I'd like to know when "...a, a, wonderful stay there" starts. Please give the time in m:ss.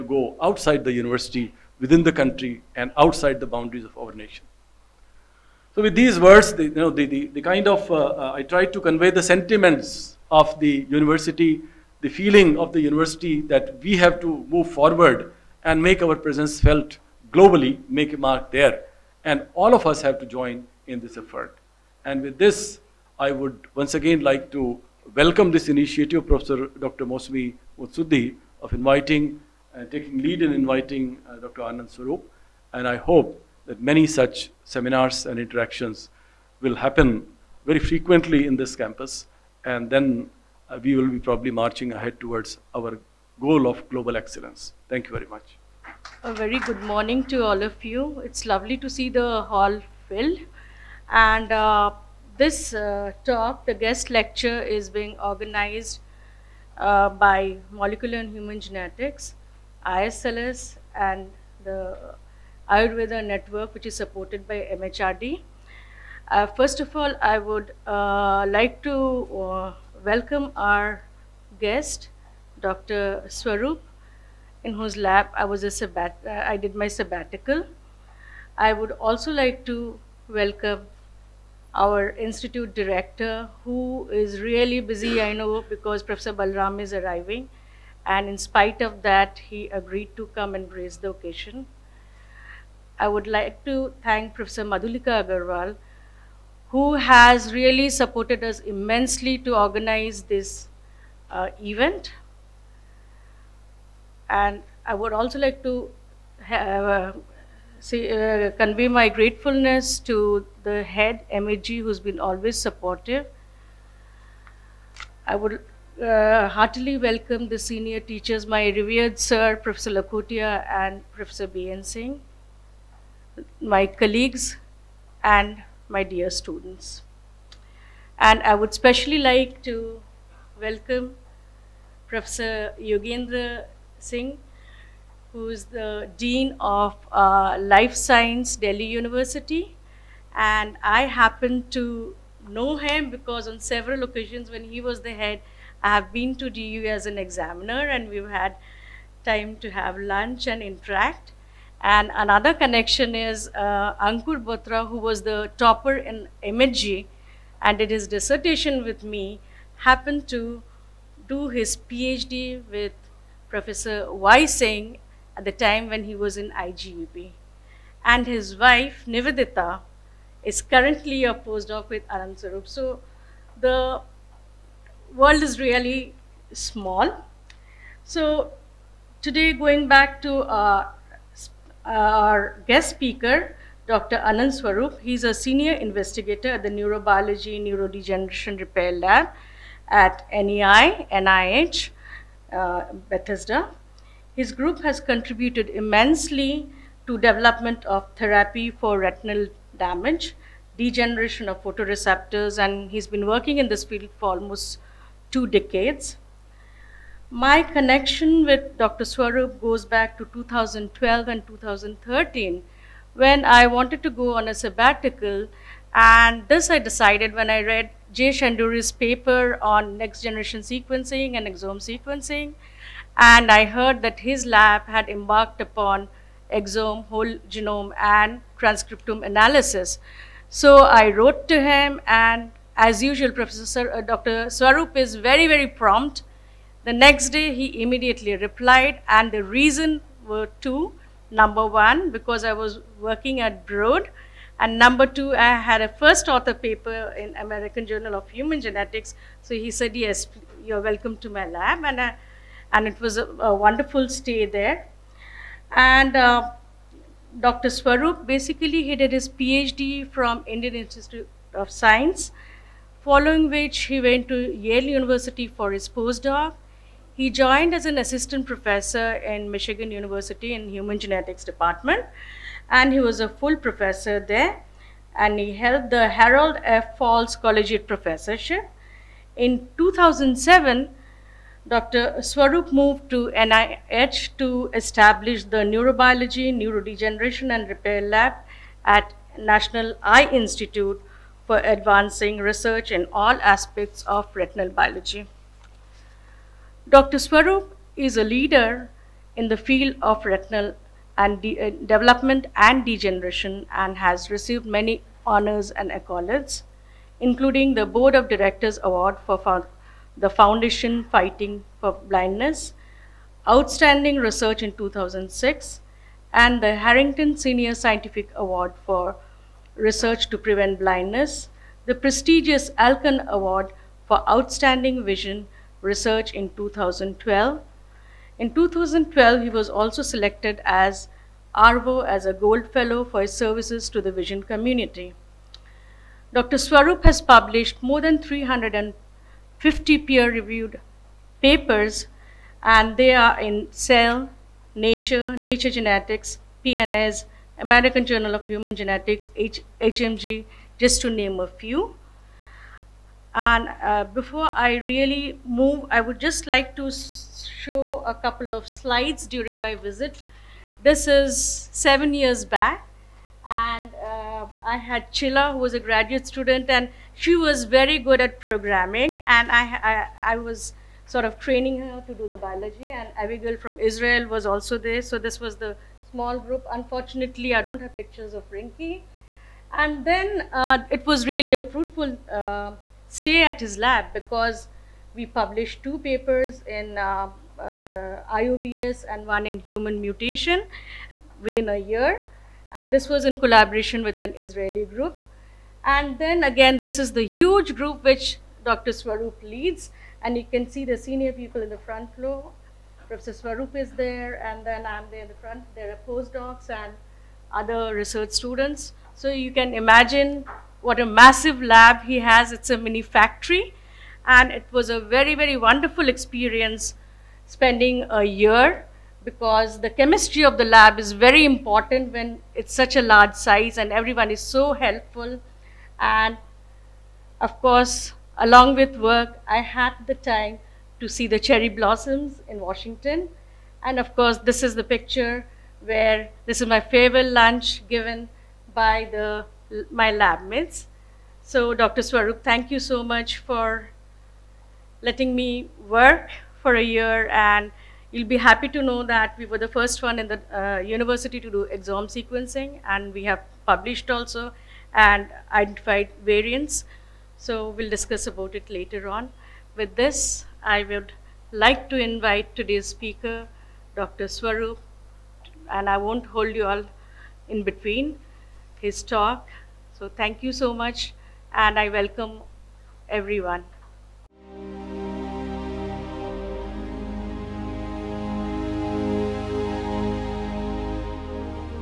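4:13.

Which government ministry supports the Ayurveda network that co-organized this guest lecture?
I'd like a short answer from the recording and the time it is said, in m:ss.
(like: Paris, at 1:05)
MHRD, at 1:04.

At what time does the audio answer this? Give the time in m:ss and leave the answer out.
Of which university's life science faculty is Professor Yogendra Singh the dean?
2:18.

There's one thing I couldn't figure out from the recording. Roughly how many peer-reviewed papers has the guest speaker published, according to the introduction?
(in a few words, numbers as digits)
more than 350.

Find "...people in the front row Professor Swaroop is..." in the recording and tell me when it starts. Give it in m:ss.
6:41.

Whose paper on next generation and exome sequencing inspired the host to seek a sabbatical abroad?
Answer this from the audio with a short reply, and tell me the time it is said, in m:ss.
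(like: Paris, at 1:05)
Jay Shendure, at 3:38.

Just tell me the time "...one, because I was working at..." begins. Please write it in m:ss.
4:01.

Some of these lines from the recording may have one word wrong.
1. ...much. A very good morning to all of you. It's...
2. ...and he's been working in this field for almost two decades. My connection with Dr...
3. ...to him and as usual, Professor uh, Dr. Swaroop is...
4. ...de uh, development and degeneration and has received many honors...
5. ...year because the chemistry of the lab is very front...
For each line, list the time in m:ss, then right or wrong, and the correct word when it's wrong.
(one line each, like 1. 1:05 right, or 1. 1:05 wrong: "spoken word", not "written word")
1. 0:45 right
2. 3:22 right
3. 3:51 right
4. 5:01 right
5. 6:58 wrong: "important", not "front".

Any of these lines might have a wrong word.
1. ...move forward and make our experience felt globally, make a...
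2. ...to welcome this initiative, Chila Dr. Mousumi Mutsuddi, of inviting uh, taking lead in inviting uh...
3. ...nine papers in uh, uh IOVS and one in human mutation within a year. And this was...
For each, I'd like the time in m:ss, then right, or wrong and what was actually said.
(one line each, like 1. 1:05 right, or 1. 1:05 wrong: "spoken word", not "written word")
1. 0:14 wrong: "presence", not "experience"
2. 0:24 wrong: "Professor", not "Chila"
3. 6:25 wrong: "two", not "nine".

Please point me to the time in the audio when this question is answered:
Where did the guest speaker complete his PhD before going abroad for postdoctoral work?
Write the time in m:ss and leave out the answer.
4:20.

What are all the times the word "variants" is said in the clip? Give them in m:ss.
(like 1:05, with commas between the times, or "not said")
7:36.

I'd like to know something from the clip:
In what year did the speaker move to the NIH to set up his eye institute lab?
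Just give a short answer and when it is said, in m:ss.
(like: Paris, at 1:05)
2007, at 4:39.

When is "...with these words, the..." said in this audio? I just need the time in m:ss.
0:05.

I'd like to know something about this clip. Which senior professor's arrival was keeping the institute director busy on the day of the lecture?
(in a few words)
Professor Balram.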